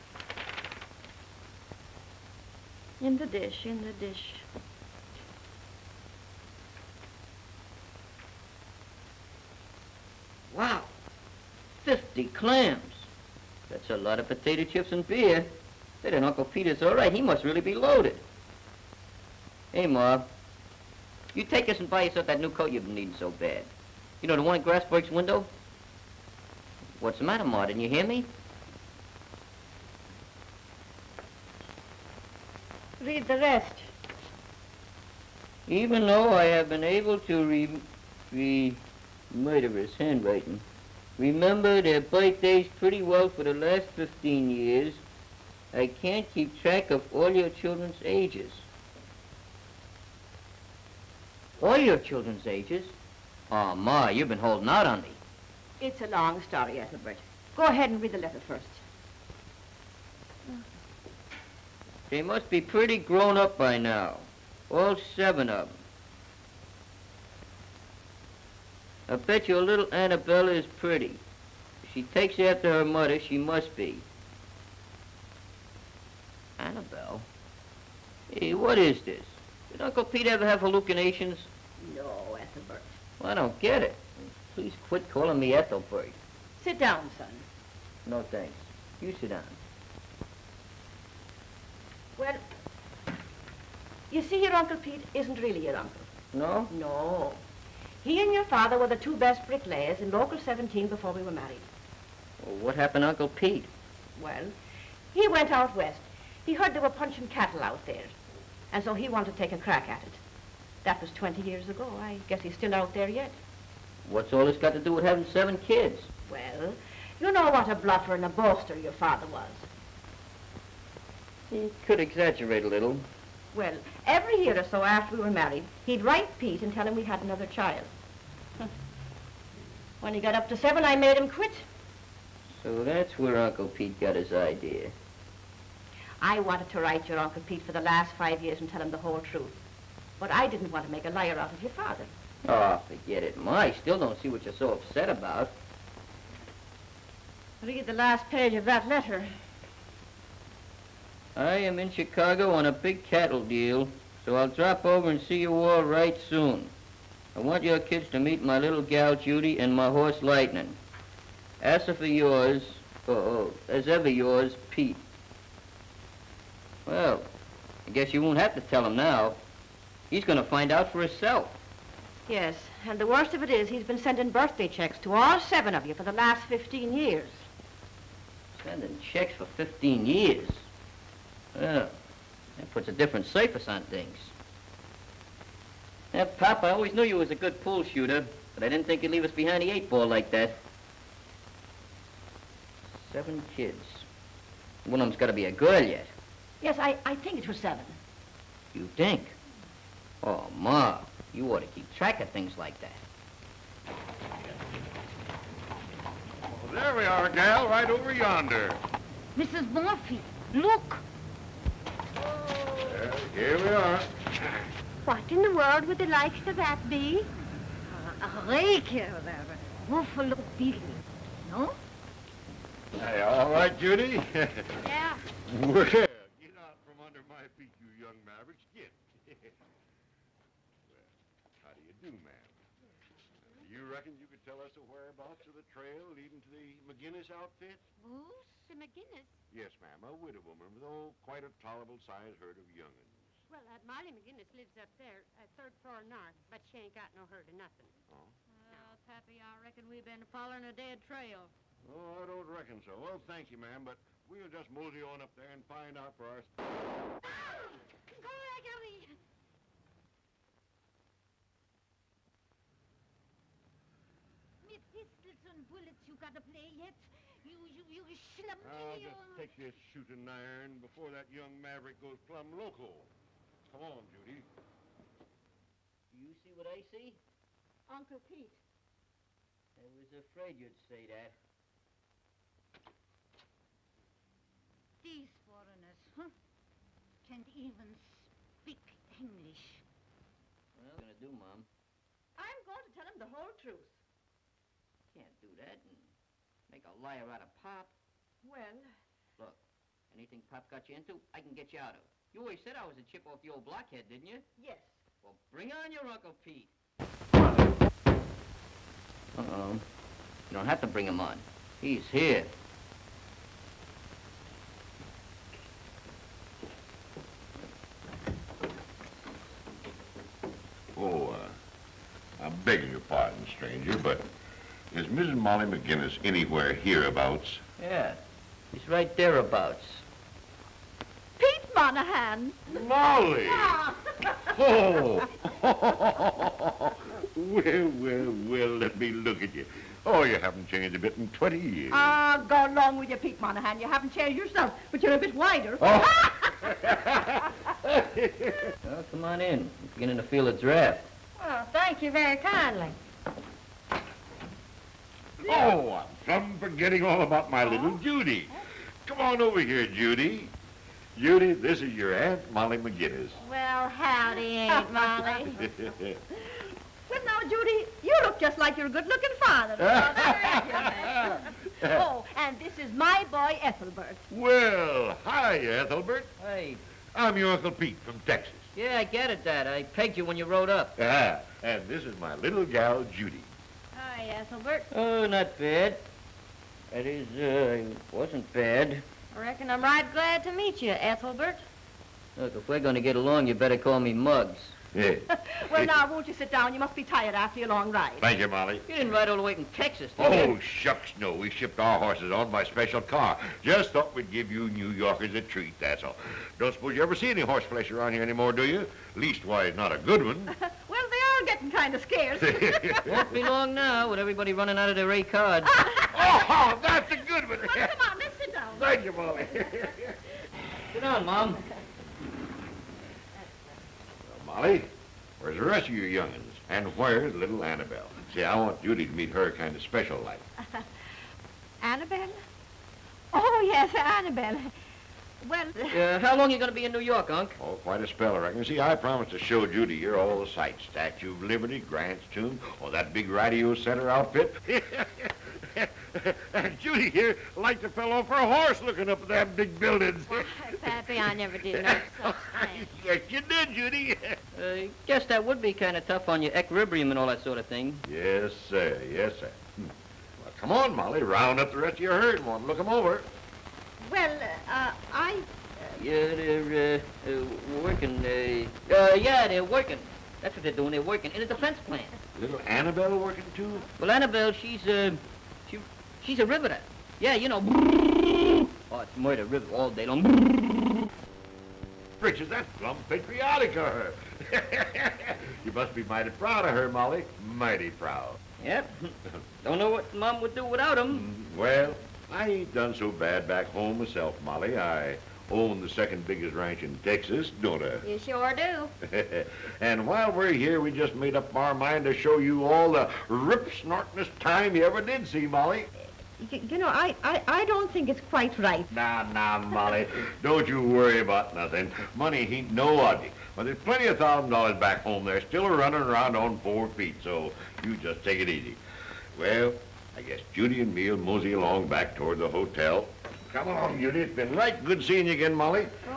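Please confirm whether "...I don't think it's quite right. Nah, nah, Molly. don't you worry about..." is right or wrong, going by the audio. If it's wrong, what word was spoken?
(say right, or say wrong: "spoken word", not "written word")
right.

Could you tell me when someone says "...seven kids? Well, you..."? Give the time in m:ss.
1:55.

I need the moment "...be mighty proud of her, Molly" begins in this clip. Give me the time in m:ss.
8:05.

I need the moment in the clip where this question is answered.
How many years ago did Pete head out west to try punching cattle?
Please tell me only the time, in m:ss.
1:51.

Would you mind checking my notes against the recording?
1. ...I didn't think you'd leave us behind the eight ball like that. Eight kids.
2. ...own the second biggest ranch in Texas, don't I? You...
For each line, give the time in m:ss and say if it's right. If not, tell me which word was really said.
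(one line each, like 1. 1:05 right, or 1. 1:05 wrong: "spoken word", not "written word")
1. 3:08 wrong: "Seven", not "Eight"
2. 8:15 right.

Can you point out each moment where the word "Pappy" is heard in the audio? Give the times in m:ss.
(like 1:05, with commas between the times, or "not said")
4:09, 7:30.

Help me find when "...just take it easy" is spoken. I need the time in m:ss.
8:37.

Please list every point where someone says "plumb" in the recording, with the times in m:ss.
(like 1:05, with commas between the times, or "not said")
4:32, 8:02.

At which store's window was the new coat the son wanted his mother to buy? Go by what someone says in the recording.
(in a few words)
Grassberg's.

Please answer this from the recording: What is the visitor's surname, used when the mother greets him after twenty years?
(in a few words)
Monahan.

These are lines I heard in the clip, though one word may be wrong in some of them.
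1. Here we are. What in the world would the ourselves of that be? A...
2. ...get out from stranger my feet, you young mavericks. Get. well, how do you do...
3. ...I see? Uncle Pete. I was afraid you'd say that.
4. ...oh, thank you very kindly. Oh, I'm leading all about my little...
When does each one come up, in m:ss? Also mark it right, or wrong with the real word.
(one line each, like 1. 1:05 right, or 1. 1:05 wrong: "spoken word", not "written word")
1. 3:33 wrong: "likes", not "ourselves"
2. 3:45 wrong: "under", not "stranger"
3. 4:36 right
4. 5:51 wrong: "forgetting", not "leading".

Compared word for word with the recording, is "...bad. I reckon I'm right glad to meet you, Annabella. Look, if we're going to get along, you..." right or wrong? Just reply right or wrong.
wrong.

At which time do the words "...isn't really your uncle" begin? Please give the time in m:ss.
1:35.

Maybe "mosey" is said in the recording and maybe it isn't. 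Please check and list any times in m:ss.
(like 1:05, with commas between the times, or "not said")
4:14, 8:41.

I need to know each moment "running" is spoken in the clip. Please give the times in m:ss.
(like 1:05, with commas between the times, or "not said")
6:54, 8:35.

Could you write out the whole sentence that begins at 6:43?
Just thought we'd give you New Yorkers a treat, that's all.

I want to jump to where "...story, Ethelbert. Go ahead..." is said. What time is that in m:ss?
0:56.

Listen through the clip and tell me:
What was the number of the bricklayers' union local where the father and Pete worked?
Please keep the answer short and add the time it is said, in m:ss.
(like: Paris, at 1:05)
17, at 1:40.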